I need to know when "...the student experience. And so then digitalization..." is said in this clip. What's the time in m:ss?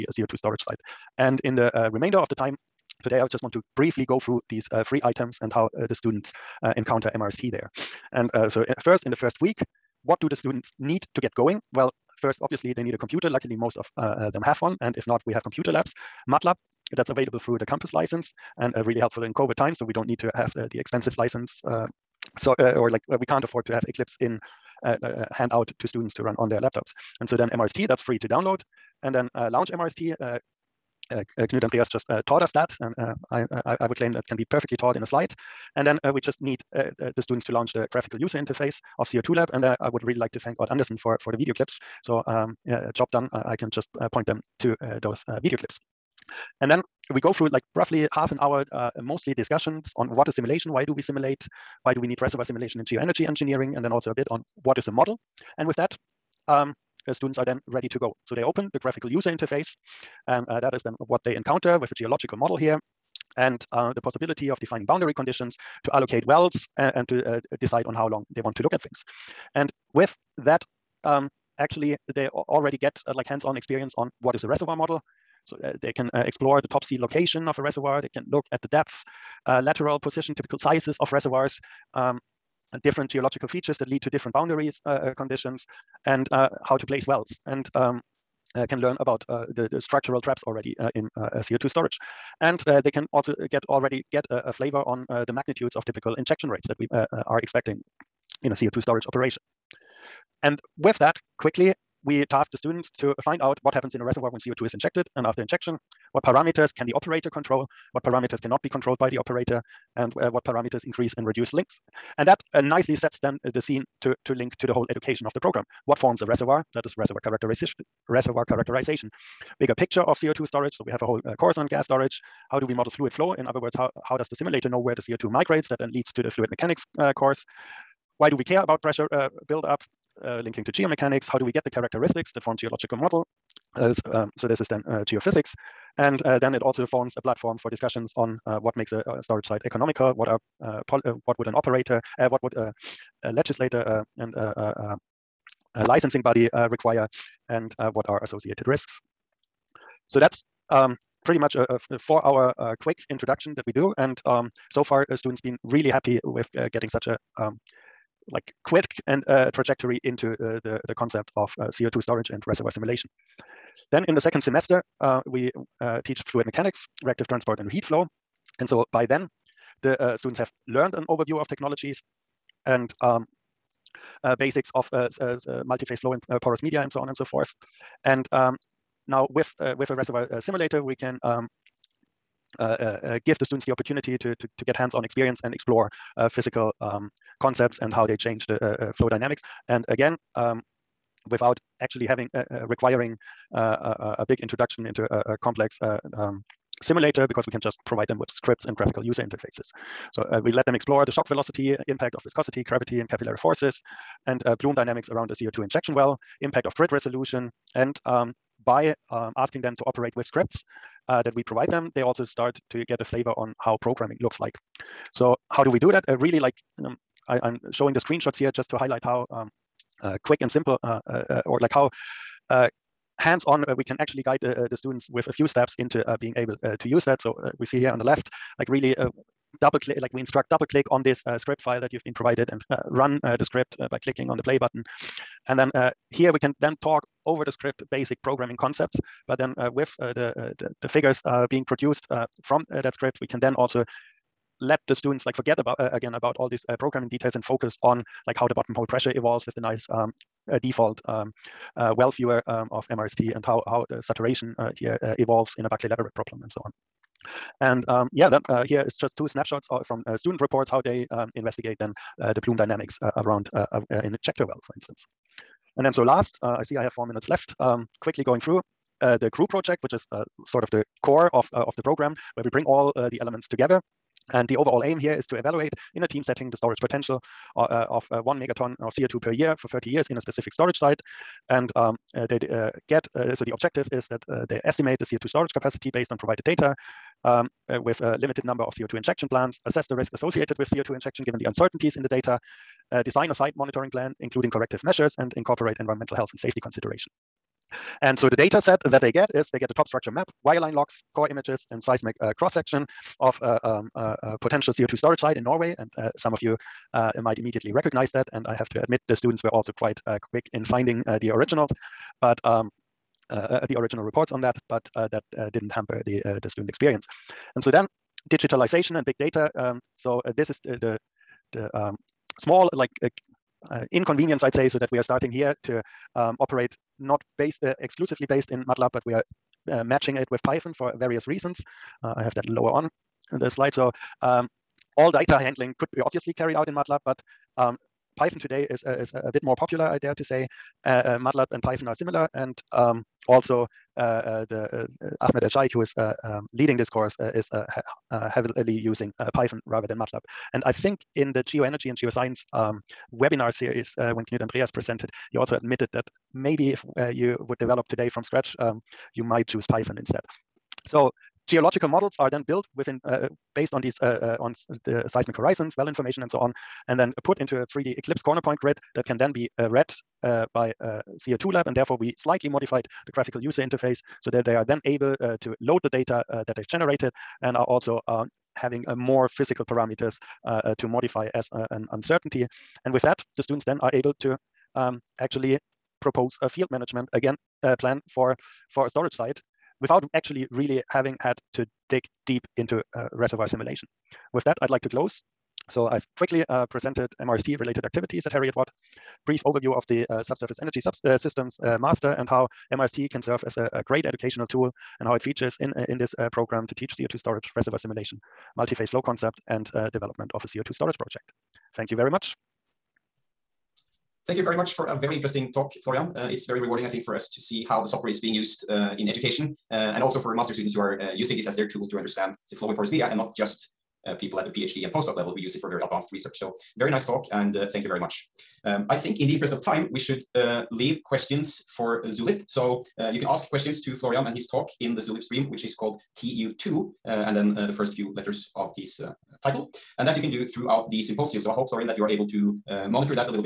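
5:16.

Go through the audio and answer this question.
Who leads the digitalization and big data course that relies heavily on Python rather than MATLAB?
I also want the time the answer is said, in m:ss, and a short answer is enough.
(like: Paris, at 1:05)
Ahmed ElSheikh, at 5:45.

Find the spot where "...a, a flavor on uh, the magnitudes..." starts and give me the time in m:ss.
1:34.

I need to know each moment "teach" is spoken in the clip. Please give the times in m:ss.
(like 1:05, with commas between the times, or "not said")
2:46, 6:46.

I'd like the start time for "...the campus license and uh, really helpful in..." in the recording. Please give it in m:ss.
0:17.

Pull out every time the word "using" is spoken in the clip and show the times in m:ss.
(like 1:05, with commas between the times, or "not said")
5:48, 7:01.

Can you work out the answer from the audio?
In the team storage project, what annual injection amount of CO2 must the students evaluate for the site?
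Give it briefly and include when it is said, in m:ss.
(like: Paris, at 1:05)
1 megaton, at 4:38.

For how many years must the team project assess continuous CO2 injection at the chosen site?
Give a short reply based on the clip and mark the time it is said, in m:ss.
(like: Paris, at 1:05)
30, at 4:39.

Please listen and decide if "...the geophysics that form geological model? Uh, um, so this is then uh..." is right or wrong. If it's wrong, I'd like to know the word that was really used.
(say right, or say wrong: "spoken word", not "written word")
wrong: "characteristics", not "geophysics".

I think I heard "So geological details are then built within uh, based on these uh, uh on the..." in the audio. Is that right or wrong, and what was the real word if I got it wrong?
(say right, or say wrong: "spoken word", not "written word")
wrong: "models", not "details".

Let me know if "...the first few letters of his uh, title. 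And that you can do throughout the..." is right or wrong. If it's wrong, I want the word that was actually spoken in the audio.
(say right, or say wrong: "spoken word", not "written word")
right.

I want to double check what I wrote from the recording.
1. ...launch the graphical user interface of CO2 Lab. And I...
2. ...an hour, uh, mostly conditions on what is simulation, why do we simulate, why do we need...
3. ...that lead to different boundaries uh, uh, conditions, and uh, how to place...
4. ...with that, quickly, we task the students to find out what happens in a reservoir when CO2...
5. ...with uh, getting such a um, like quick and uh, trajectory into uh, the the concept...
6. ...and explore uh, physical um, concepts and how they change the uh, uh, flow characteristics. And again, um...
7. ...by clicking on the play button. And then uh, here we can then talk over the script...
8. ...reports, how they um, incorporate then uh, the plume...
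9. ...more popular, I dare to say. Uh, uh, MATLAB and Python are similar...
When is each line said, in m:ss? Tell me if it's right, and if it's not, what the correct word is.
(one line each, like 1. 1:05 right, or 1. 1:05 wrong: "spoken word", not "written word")
1. 0:37 right
2. 0:48 wrong: "discussions", not "conditions"
3. 1:23 right
4. 1:40 right
5. 2:36 right
6. 3:05 wrong: "dynamics", not "characteristics"
7. 3:53 right
8. 4:20 wrong: "investigate", not "incorporate"
9. 5:39 right.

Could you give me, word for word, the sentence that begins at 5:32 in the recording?
I have that lower on the slide.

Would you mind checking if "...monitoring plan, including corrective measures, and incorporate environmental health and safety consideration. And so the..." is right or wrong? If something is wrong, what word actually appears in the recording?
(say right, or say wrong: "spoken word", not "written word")
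right.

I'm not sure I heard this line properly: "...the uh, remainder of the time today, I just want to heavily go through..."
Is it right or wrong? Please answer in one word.
wrong.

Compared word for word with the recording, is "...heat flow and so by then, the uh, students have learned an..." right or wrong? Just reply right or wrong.
right.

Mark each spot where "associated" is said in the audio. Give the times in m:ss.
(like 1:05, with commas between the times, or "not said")
2:28, 4:50.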